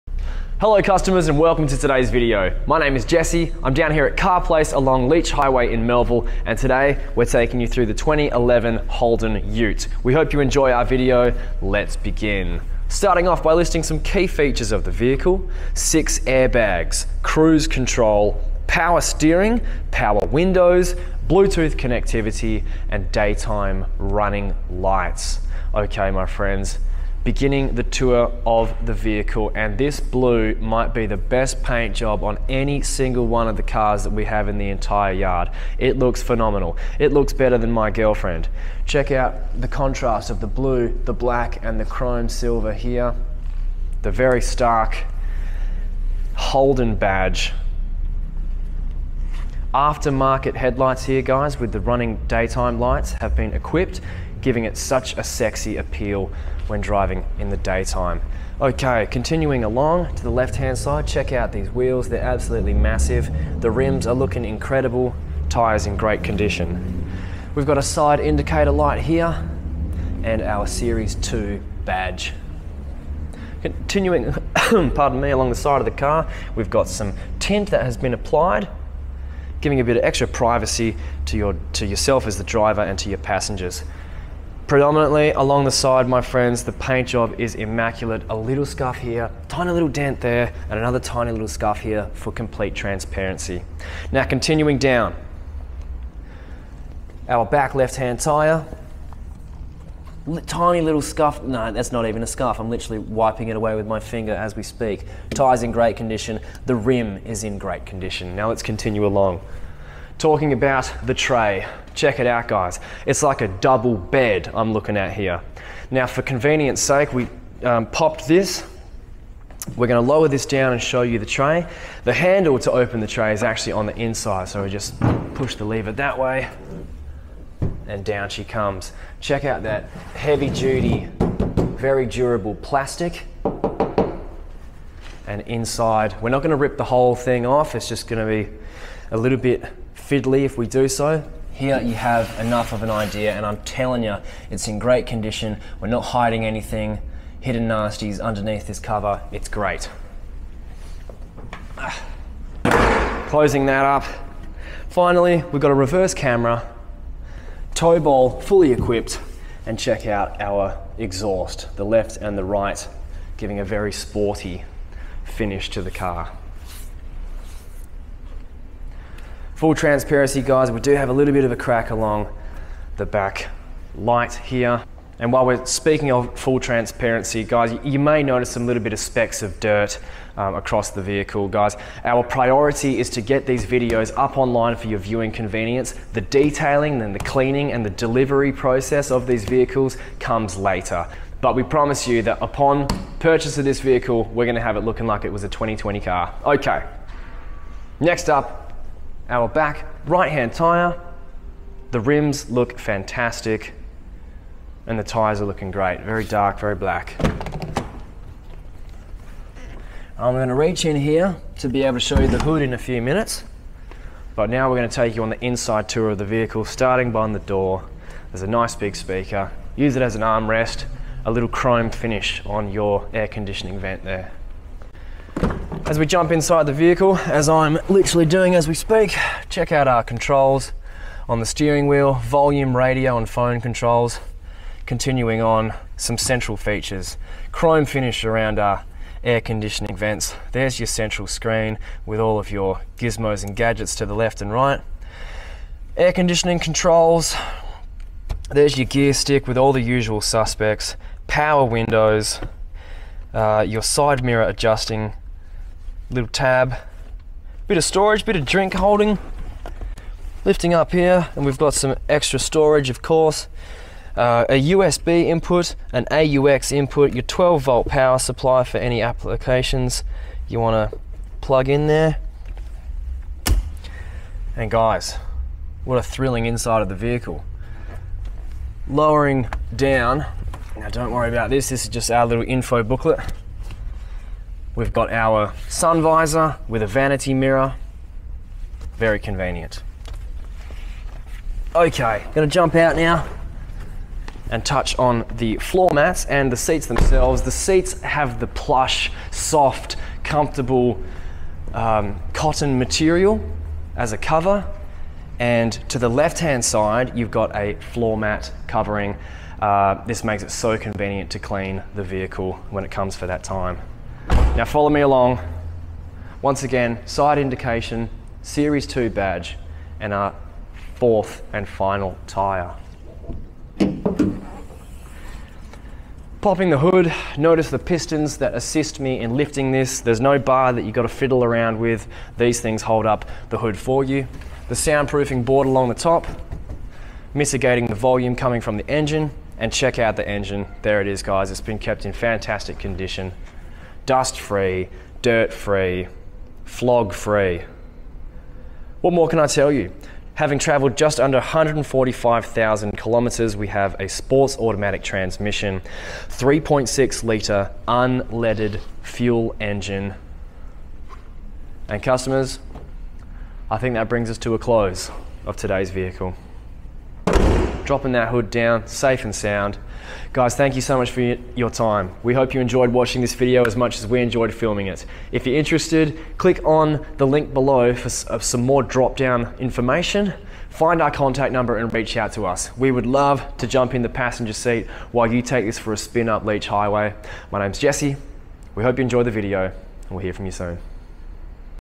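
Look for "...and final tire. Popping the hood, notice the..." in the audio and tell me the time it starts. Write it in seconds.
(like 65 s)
321 s.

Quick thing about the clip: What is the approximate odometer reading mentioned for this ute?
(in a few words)
just under 145,000 kilometres.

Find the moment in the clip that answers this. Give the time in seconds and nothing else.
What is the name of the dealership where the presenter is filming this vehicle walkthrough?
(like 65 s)
4 s.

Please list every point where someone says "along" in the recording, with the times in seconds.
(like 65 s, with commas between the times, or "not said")
4 s, 59 s, 75 s, 85 s, 109 s, 171 s, 314 s, 335 s.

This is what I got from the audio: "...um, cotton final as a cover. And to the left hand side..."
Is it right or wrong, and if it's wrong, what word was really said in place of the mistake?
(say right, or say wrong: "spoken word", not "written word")
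wrong: "material", not "final".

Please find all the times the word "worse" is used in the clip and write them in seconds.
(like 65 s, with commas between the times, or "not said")
not said.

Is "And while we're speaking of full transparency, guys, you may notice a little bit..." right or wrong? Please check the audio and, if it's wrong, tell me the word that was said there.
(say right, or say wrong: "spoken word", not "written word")
right.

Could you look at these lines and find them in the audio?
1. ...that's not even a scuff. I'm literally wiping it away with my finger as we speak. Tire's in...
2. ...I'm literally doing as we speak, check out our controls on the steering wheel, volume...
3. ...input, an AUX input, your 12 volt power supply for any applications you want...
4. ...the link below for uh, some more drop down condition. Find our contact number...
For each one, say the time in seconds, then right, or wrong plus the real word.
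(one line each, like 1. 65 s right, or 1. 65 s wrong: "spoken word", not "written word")
1. 101 s right
2. 227 s right
3. 265 s right
4. 377 s wrong: "information", not "condition".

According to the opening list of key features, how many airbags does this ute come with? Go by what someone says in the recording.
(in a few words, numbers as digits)
6.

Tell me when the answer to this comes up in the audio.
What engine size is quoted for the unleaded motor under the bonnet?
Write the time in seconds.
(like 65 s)
356 s.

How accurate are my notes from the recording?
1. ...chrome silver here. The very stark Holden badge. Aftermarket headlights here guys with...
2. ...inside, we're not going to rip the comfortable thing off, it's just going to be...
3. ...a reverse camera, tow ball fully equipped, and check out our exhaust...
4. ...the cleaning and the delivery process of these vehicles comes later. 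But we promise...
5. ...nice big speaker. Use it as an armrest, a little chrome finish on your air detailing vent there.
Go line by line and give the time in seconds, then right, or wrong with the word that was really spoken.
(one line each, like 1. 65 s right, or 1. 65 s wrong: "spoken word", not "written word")
1. 41 s right
2. 135 s wrong: "whole", not "comfortable"
3. 155 s right
4. 187 s right
5. 218 s wrong: "conditioning", not "detailing".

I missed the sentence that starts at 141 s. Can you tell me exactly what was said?
Here you have enough of an idea, and I'm telling you, it's in great condition.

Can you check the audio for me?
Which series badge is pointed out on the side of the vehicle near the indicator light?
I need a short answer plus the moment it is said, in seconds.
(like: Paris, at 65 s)
Series 2, at 70 s.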